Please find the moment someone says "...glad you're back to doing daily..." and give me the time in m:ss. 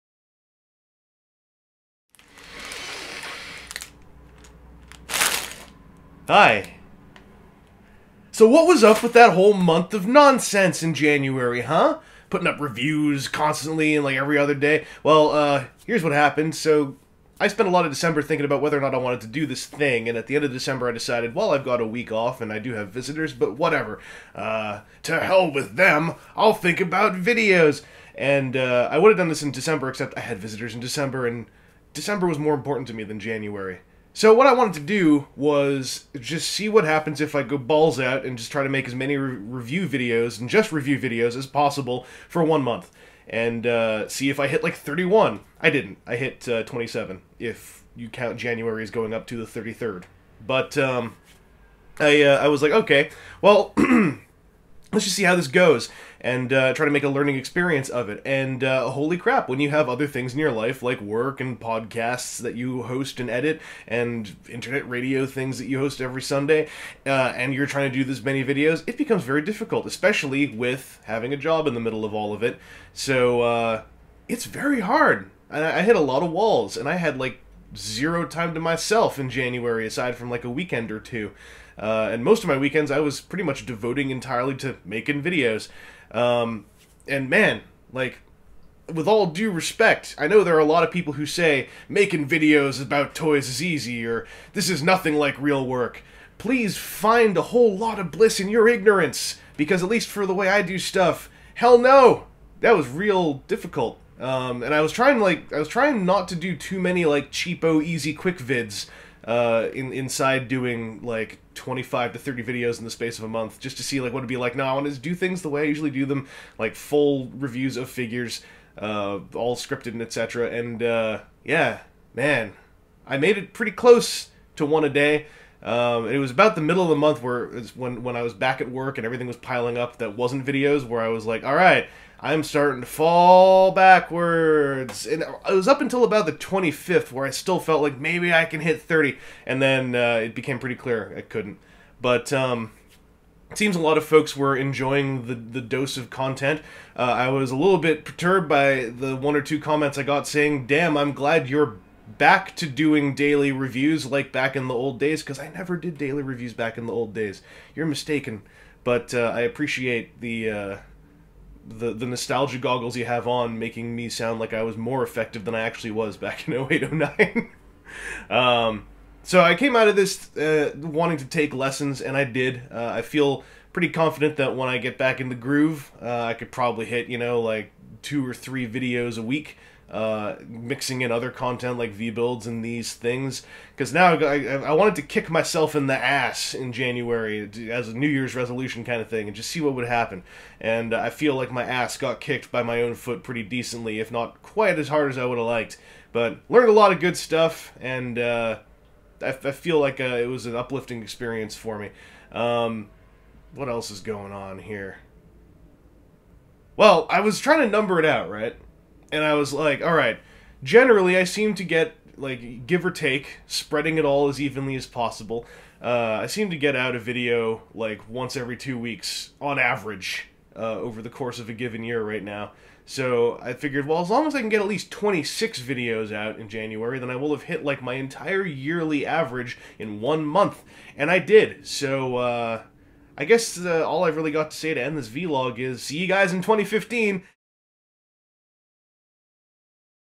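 2:31.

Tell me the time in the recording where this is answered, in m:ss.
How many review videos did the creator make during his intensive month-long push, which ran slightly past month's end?
0:46.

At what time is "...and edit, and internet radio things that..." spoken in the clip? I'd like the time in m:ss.
1:03.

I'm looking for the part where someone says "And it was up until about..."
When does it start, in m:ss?
2:15.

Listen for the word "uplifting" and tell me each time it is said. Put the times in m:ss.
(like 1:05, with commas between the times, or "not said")
3:20.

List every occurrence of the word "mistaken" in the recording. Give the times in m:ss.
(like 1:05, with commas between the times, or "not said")
2:37.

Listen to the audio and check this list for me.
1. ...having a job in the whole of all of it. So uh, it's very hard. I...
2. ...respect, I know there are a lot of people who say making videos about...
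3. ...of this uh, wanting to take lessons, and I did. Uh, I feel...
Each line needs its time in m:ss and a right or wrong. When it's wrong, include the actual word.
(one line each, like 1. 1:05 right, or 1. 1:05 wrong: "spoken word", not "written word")
1. 1:11 wrong: "middle", not "whole"
2. 1:29 right
3. 2:49 right.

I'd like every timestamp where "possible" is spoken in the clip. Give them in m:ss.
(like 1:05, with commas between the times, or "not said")
0:41, 3:34.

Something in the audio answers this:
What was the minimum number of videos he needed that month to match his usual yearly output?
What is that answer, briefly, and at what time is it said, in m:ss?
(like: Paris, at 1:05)
26, at 3:44.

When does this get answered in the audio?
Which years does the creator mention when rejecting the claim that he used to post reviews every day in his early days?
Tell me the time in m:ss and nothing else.
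2:46.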